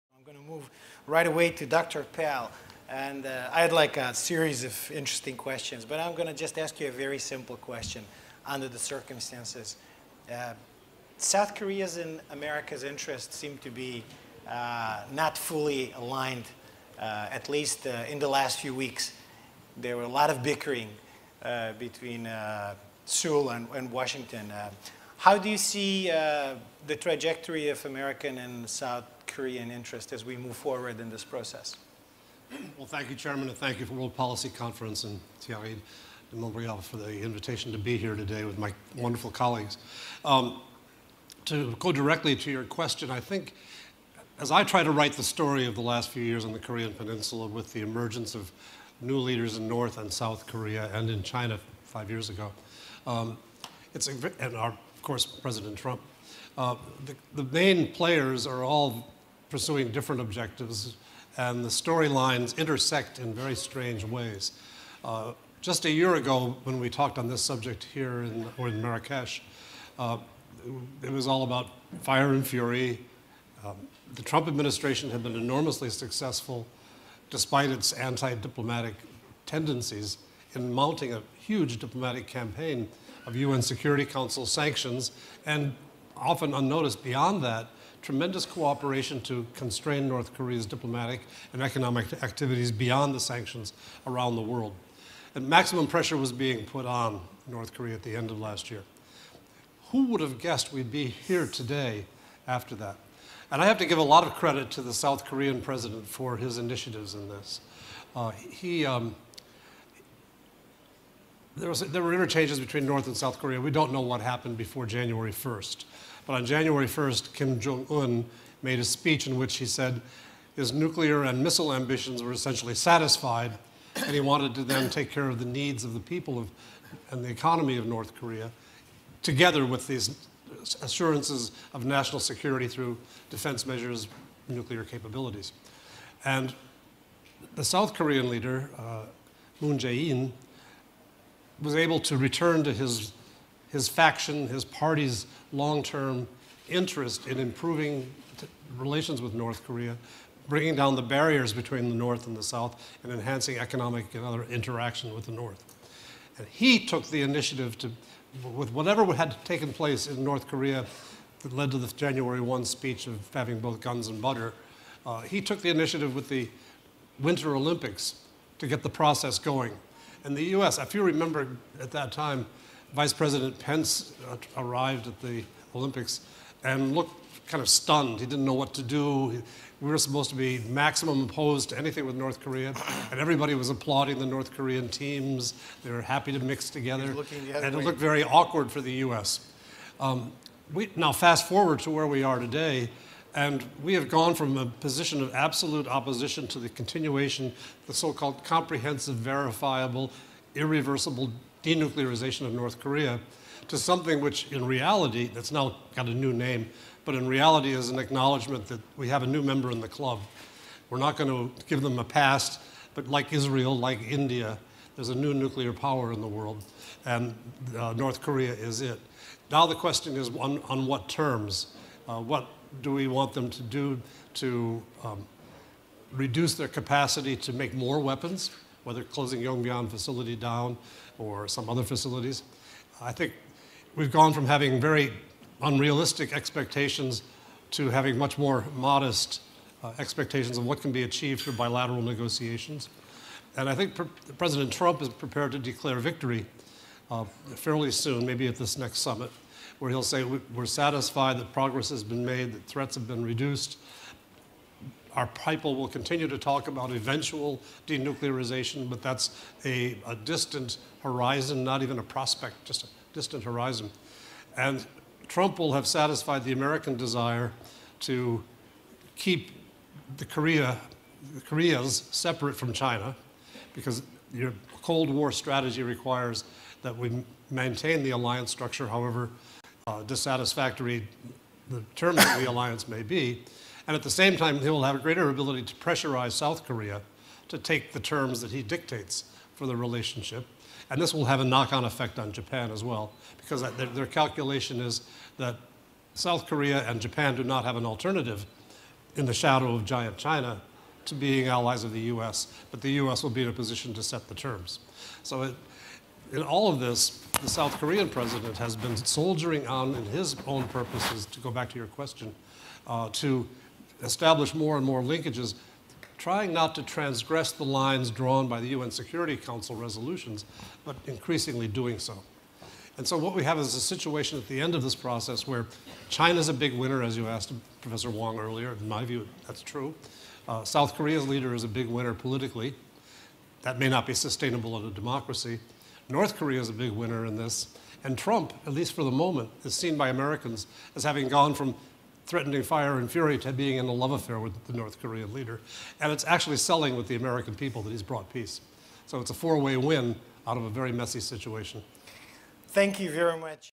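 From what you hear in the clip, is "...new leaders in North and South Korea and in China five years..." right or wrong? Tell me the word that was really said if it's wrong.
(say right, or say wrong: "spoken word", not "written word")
right.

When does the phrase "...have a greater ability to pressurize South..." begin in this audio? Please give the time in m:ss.
4:44.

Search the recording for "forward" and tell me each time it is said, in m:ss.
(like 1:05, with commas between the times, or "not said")
0:30, 3:11.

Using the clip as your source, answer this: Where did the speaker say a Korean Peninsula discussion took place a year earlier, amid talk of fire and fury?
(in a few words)
Marrakesh.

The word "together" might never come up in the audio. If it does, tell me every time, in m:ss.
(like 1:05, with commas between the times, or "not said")
2:09, 3:06.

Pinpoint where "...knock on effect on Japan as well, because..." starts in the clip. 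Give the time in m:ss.
4:51.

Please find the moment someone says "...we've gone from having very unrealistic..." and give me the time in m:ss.
3:53.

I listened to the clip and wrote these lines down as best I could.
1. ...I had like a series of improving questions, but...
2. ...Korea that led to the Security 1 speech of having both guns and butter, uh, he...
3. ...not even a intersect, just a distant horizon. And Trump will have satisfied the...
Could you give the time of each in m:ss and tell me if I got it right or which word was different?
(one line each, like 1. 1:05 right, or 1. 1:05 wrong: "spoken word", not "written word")
1. 0:03 wrong: "interesting", not "improving"
2. 2:40 wrong: "January", not "Security"
3. 4:21 wrong: "prospect", not "intersect".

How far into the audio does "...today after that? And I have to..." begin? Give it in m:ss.
1:41.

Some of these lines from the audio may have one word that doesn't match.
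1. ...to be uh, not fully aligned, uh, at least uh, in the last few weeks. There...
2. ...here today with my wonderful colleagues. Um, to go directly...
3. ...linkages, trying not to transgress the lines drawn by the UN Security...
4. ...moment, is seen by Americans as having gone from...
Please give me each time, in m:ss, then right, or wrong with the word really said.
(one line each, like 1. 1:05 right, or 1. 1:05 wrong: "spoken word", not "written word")
1. 0:13 right
2. 0:37 right
3. 5:15 right
4. 5:39 right.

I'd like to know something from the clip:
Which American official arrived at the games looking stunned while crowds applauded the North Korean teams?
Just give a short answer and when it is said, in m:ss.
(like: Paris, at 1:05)
Vice President Pence, at 2:52.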